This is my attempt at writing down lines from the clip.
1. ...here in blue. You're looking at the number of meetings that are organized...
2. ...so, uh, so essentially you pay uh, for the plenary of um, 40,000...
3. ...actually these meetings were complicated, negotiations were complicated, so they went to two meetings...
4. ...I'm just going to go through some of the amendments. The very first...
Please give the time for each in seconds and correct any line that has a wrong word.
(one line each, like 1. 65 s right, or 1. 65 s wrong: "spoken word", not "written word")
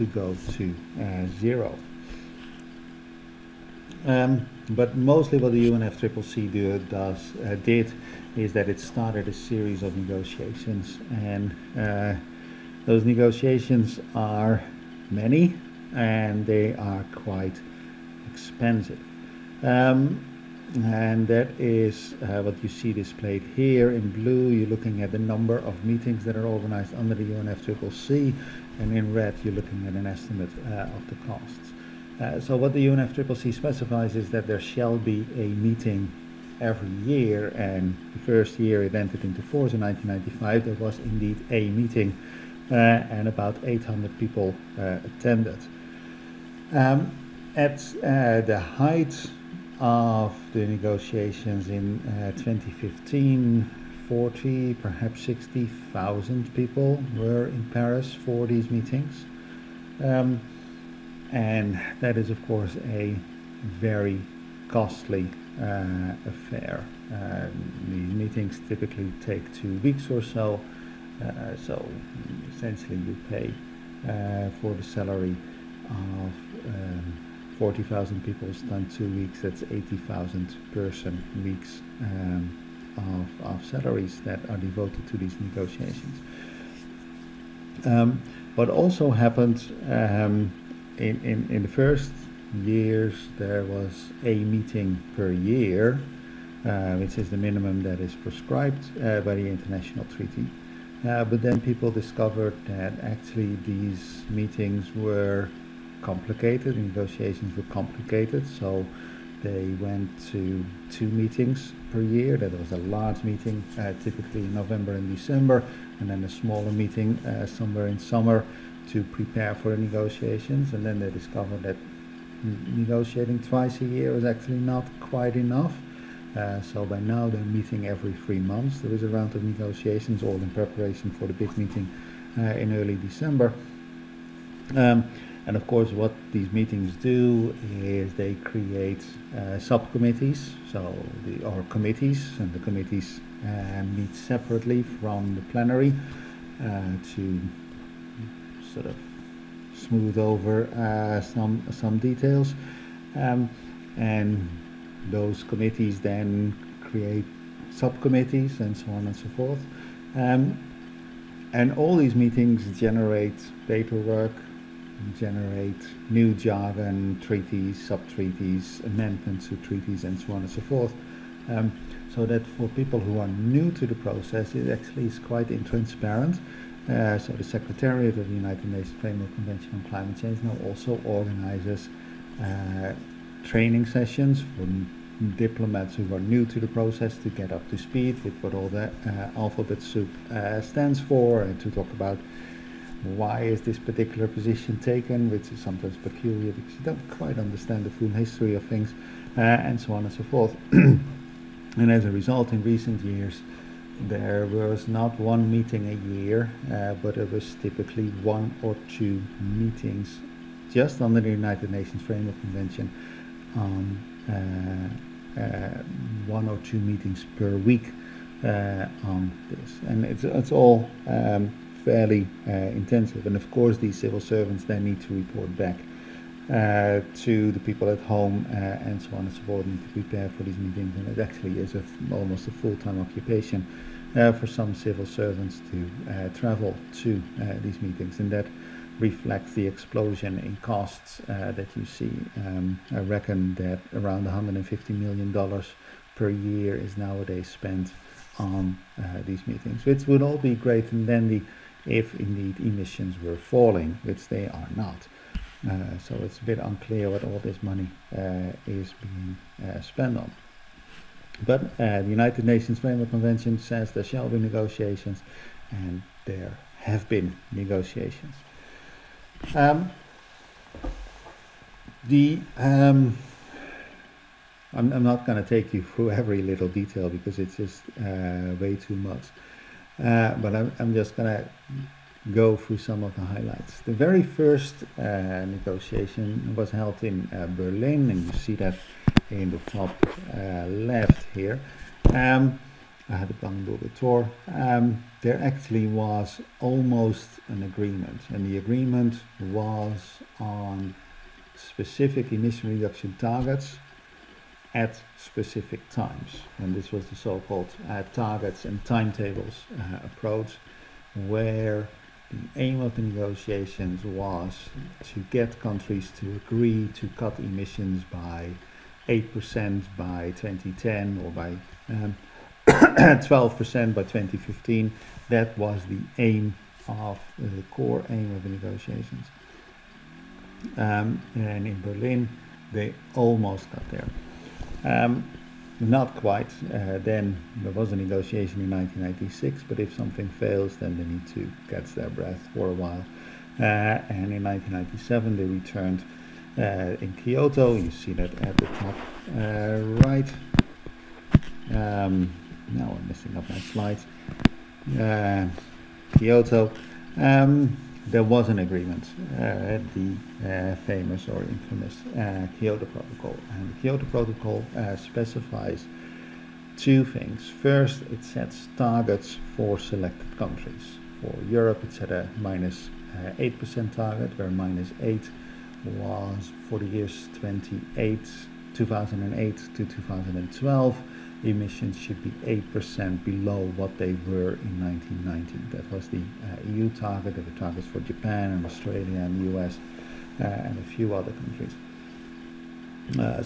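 1. 23 s right
2. 70 s wrong: "salary", not "plenary"
3. 103 s right
4. 280 s wrong: "highlights", not "amendments".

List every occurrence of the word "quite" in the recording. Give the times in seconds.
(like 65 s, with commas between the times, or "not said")
17 s, 125 s, 175 s, 197 s, 336 s.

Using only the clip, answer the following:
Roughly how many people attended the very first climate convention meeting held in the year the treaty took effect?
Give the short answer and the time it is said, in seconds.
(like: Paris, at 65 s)
800, at 43 s.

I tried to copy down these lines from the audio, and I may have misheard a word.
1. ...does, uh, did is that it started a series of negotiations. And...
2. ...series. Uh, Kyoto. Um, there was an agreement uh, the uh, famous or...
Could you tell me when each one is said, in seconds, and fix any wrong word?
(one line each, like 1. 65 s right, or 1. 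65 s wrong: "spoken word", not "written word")
1. 6 s right
2. 353 s wrong: "slides", not "series".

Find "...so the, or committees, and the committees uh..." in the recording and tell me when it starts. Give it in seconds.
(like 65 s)
140 s.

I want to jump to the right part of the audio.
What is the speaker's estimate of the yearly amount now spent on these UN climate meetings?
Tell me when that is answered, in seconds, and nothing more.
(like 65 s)
244 s.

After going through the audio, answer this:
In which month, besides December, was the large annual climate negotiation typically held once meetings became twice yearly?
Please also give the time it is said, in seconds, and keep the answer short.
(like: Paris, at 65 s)
November, at 114 s.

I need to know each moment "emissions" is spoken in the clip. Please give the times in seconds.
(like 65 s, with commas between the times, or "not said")
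252 s, 302 s, 317 s, 381 s.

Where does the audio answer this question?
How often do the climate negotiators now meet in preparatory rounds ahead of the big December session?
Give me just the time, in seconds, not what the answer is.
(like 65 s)
127 s.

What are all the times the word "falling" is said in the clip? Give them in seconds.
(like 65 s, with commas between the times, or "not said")
253 s.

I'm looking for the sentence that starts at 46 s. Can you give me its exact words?
Um, at uh, the height of the negotiations in uh, 2015, 40, perhaps 60,000 people were in Paris for these meetings.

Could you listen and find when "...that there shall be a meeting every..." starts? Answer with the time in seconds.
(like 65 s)
34 s.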